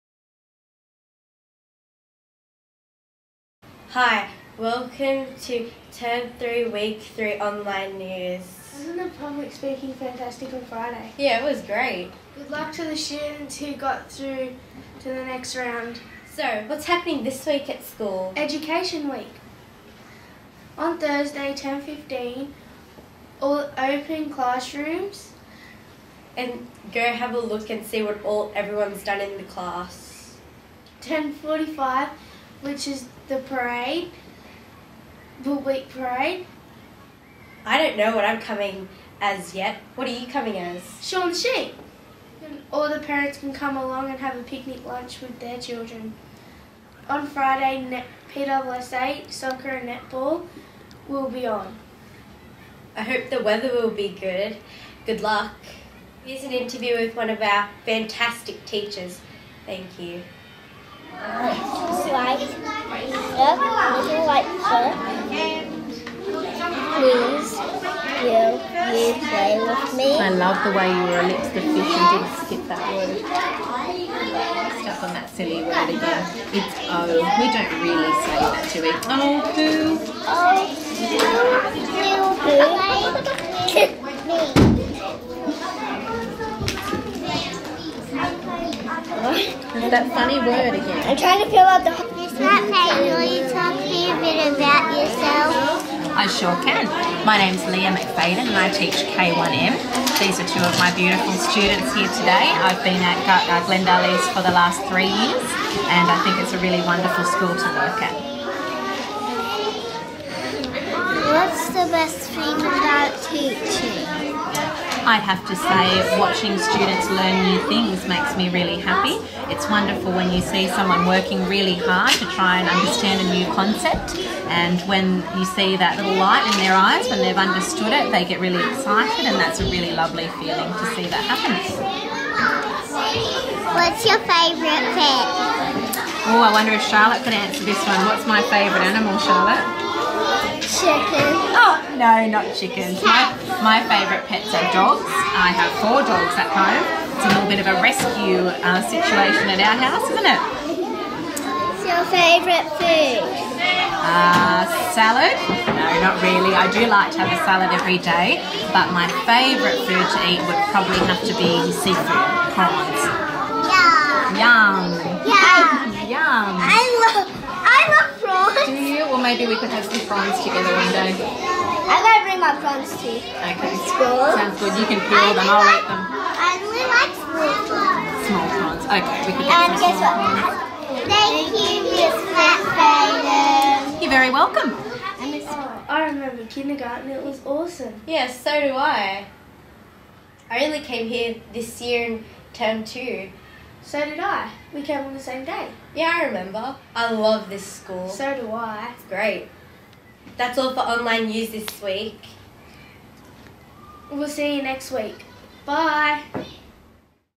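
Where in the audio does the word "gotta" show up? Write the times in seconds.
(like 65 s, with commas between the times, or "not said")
172 s.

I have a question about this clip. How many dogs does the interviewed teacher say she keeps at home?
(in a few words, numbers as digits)
4.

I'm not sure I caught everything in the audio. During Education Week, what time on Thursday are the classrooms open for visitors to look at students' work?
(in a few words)
10:15.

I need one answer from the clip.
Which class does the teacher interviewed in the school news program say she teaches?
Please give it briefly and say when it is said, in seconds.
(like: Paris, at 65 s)
K1M, at 99 s.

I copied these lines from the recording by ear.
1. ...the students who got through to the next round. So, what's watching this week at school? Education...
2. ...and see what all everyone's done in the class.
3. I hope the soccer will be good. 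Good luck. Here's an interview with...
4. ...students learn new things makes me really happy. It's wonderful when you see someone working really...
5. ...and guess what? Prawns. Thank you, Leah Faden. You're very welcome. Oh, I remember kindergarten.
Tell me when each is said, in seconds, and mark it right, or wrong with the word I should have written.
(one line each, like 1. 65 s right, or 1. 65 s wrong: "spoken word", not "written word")
1. 12 s wrong: "happening", not "watching"
2. 27 s right
3. 52 s wrong: "weather", not "soccer"
4. 116 s right
5. 179 s wrong: "Miss", not "Leah".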